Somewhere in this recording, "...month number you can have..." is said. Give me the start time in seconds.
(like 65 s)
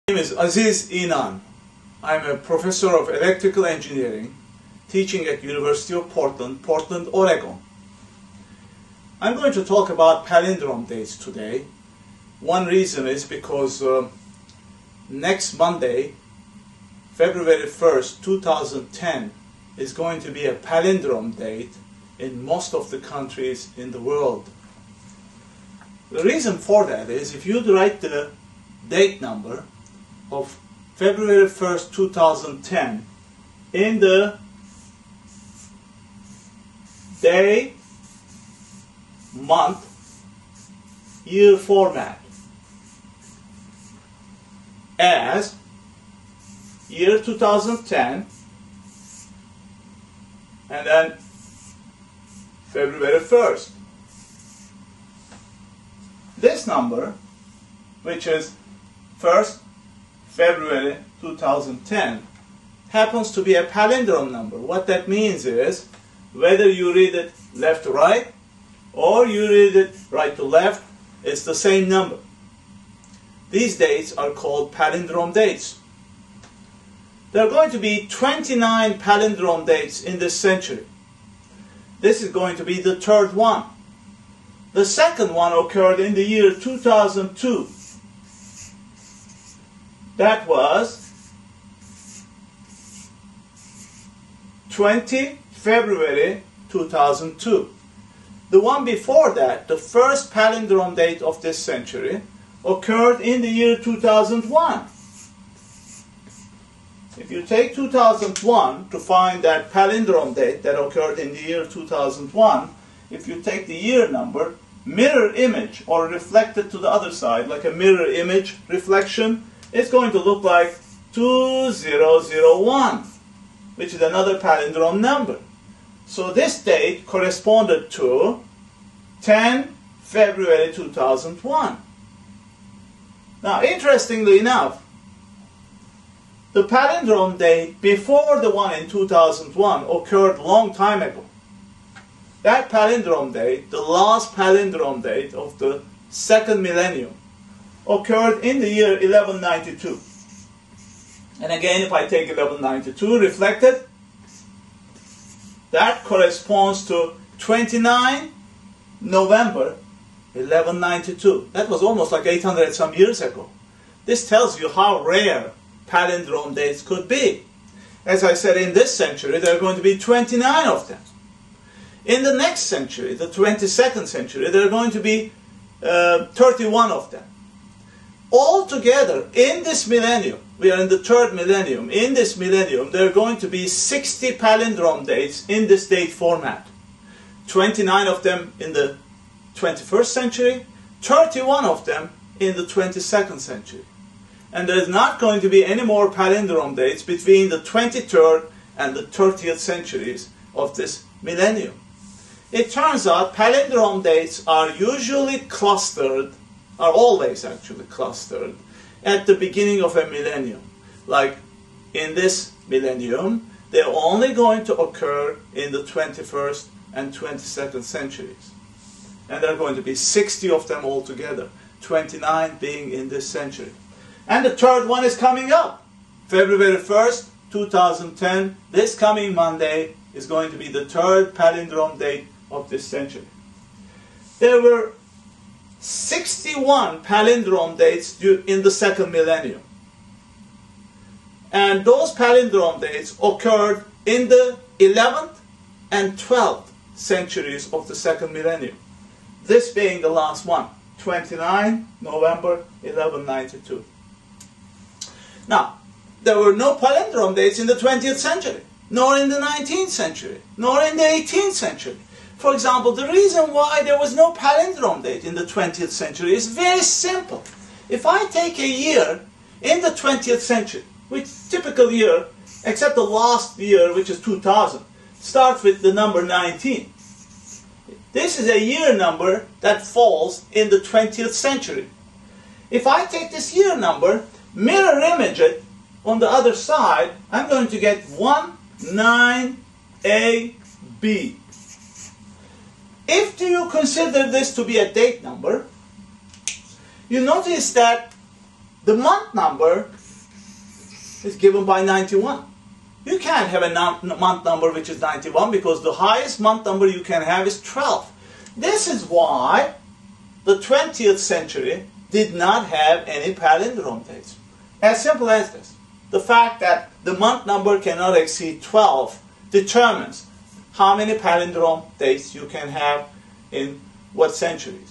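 306 s.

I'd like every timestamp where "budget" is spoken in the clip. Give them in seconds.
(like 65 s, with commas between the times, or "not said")
not said.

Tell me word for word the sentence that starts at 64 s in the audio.
What that means is whether you read it left to right or you read it right to left, it's the same number.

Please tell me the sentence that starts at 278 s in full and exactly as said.
This is a year number that falls in the 20th century.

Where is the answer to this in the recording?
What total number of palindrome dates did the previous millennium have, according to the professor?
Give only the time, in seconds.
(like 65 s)
235 s.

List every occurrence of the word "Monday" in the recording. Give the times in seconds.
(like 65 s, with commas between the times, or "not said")
15 s, 229 s.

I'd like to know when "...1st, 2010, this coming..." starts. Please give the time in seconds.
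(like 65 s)
226 s.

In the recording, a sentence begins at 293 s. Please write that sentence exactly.
If you consider this to be a date number, you notice that the month number is given by 91.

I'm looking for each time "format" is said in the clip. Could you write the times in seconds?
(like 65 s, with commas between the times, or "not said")
41 s, 186 s.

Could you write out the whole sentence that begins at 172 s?
In the next century, the 22nd century, there are going to be uh, 31 of them.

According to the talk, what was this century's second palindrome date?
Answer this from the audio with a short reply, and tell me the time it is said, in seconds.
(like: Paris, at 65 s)
20 February 2002, at 94 s.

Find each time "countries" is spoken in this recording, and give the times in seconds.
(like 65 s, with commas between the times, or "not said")
22 s.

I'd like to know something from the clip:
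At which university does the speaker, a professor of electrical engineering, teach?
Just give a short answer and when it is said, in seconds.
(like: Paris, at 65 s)
University of Portland, at 5 s.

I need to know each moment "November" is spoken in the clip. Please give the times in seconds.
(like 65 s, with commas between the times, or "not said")
159 s, 251 s.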